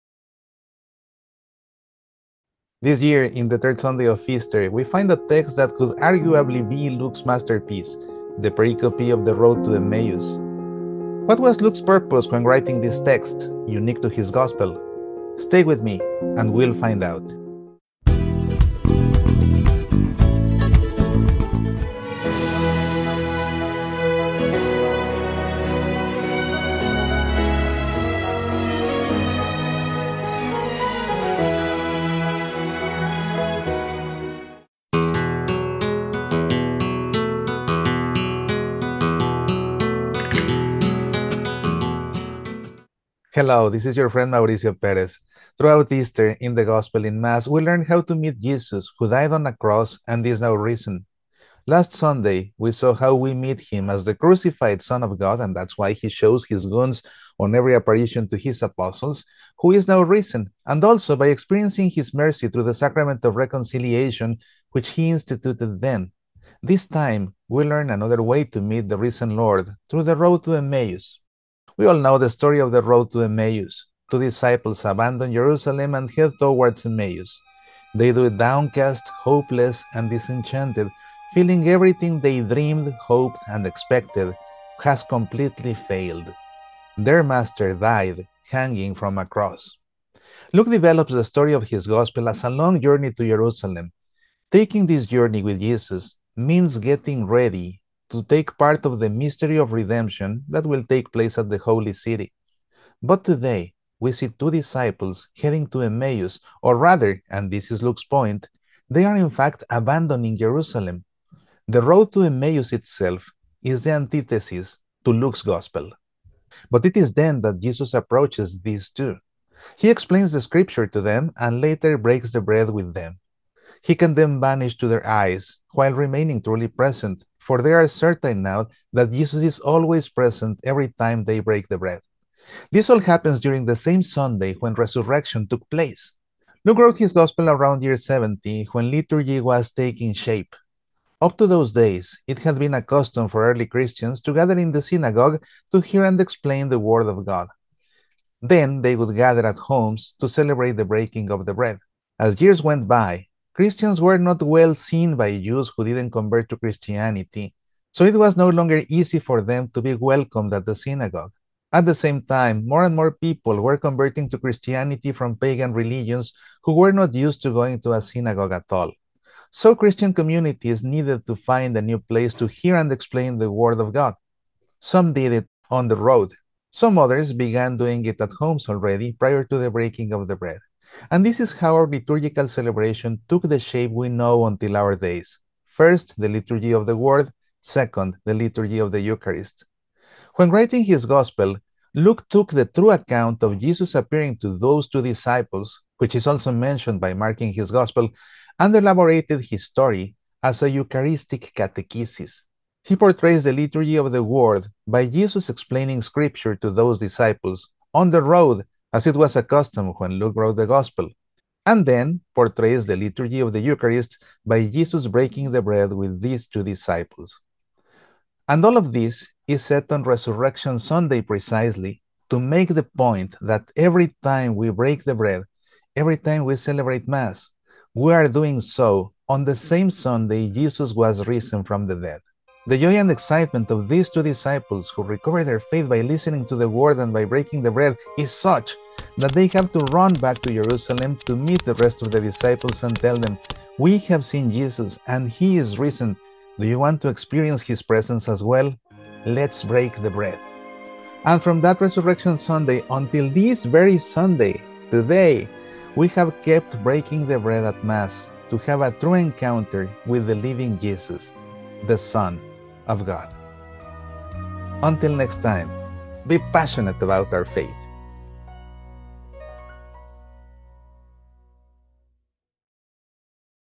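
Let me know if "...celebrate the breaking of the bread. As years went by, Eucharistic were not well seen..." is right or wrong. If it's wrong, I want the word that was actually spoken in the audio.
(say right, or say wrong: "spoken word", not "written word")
wrong: "Christians", not "Eucharistic".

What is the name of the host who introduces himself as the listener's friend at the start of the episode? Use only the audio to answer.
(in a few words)
Mauricio Perez.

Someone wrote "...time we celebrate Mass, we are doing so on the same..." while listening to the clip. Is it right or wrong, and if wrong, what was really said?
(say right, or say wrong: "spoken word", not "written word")
right.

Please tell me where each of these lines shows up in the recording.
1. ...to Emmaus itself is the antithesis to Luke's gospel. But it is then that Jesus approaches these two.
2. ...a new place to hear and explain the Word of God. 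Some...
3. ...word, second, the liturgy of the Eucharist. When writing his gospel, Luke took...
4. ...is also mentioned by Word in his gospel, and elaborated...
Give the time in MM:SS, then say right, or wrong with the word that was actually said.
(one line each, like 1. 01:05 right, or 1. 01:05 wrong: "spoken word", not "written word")
1. 01:52 right
2. 02:51 right
3. 03:06 right
4. 03:16 wrong: "Mark", not "Word".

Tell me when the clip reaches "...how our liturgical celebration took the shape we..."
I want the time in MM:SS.
03:01.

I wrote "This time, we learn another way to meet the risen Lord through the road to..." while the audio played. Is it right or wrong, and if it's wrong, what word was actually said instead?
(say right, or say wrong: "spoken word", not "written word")
right.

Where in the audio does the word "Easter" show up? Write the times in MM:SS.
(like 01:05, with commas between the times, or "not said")
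00:04, 00:45.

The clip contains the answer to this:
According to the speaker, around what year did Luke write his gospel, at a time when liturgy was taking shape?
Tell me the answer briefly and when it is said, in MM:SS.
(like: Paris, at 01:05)
70, at 02:17.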